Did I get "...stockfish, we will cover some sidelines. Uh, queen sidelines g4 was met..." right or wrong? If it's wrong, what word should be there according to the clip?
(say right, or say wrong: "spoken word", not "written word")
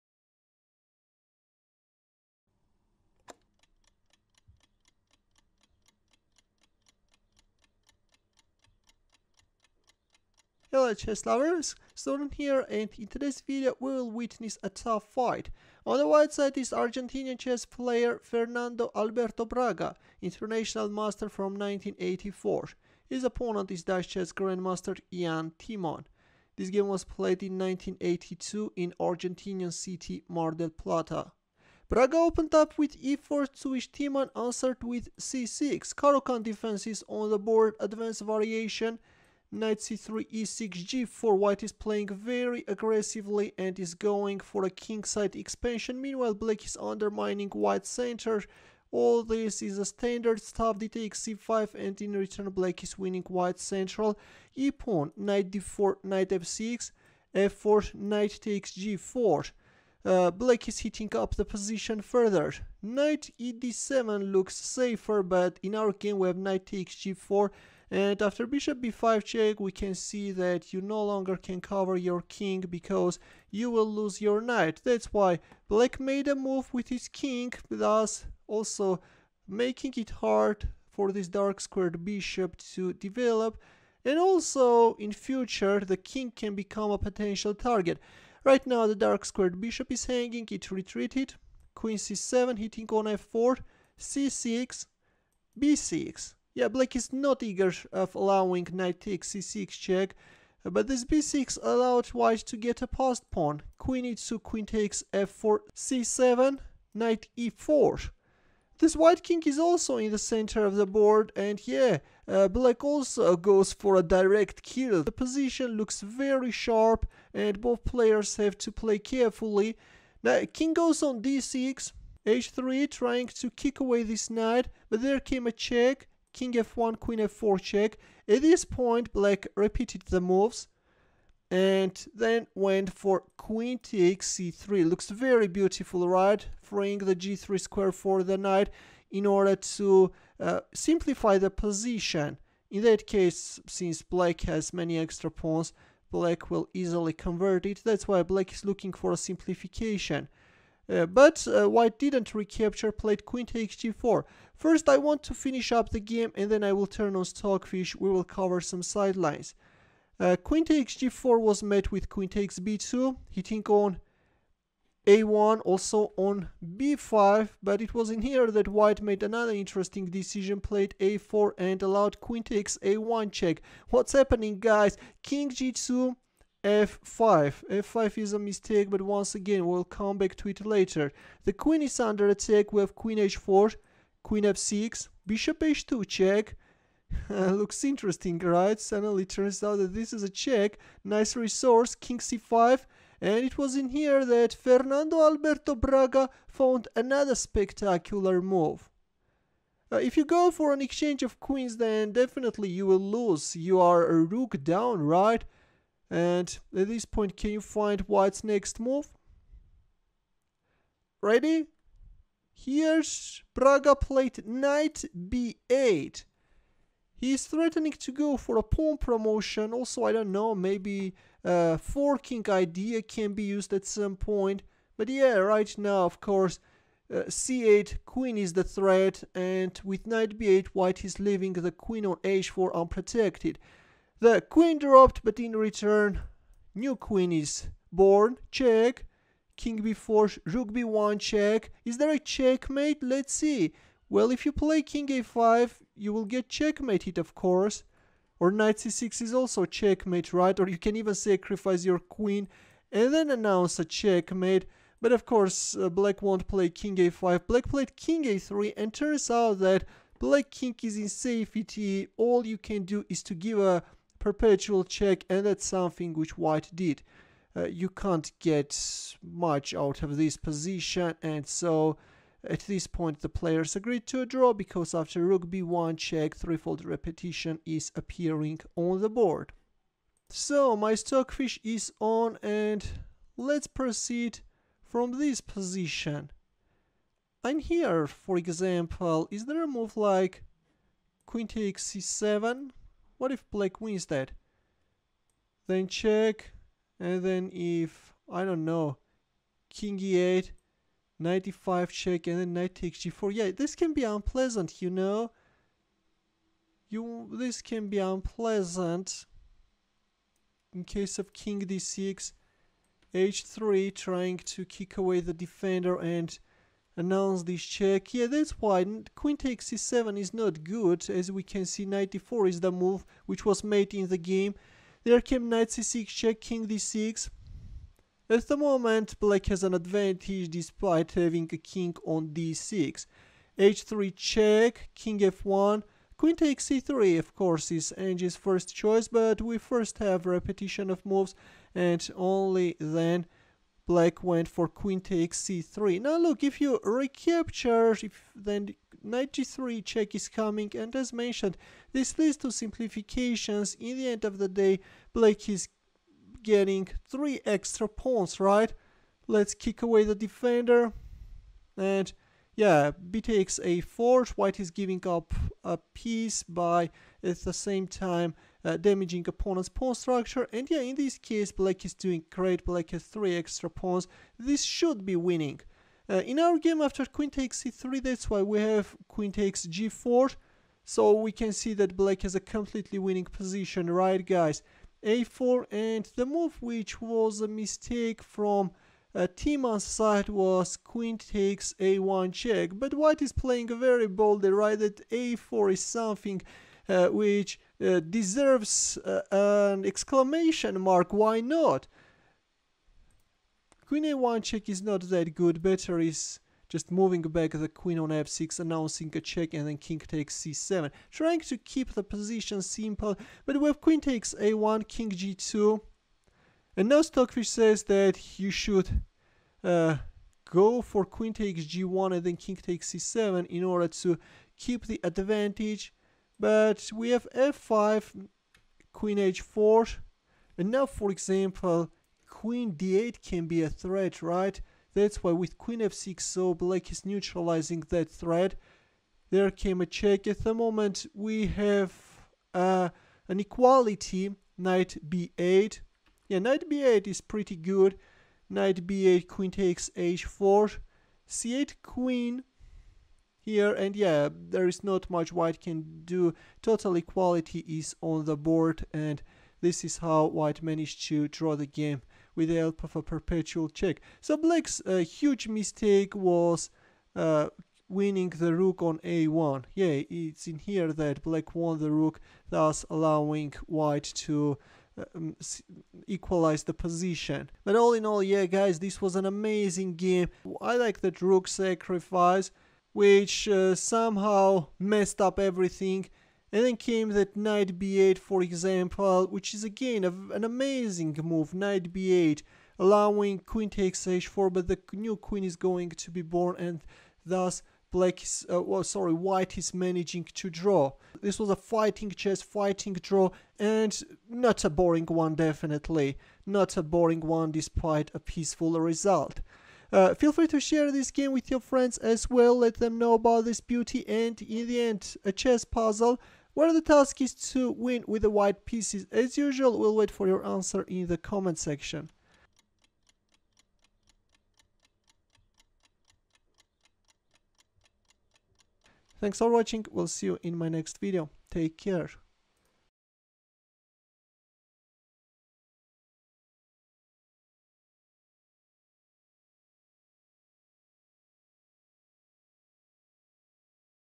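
wrong: "takes", not "sidelines".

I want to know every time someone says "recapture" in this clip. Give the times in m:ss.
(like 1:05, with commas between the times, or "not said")
2:32, 5:46.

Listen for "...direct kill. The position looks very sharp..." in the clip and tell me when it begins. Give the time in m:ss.
1:54.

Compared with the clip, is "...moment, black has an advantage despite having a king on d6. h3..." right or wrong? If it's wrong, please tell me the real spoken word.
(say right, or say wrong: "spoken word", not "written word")
right.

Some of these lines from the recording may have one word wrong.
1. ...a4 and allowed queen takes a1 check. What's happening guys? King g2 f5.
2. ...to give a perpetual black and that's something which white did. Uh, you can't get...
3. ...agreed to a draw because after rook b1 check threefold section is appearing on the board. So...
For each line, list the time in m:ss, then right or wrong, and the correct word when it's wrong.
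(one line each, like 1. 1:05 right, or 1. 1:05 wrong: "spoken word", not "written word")
1. 2:50 right
2. 4:23 wrong: "check", not "black"
3. 4:33 wrong: "repetition", not "section".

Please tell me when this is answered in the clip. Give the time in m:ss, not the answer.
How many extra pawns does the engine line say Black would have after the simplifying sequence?
5:57.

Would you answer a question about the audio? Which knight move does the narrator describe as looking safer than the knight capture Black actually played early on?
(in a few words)
Knight e d7.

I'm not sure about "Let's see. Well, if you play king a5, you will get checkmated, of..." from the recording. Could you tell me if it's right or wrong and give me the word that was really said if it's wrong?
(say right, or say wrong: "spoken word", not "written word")
right.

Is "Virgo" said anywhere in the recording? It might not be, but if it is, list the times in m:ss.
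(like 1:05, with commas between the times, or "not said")
not said.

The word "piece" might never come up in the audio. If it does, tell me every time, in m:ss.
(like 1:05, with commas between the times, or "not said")
6:05, 8:38.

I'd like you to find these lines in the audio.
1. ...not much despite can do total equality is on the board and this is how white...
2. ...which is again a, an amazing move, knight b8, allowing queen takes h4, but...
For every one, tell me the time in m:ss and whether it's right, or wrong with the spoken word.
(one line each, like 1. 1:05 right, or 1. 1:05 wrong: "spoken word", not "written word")
1. 7:34 wrong: "white", not "despite"
2. 8:09 right.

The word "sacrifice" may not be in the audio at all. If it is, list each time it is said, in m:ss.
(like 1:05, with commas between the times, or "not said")
4:11, 8:01.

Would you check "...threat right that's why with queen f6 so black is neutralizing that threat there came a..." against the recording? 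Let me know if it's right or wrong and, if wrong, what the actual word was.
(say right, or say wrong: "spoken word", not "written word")
right.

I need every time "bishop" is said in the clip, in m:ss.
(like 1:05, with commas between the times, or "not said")
1:08, 1:22, 1:29, 3:05.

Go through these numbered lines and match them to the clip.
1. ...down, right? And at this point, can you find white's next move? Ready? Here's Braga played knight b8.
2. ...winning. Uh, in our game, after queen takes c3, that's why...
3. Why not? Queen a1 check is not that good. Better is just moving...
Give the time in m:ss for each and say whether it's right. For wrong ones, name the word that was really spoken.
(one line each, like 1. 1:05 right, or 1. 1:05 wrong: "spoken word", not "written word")
1. 3:24 right
2. 6:15 right
3. 6:41 right.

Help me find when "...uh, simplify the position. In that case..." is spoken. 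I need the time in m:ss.
2:20.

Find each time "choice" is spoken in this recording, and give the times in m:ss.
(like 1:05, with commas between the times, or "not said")
5:38.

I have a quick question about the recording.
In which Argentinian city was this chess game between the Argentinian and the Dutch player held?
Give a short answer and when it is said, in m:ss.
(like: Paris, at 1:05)
Mar del Plata, at 0:30.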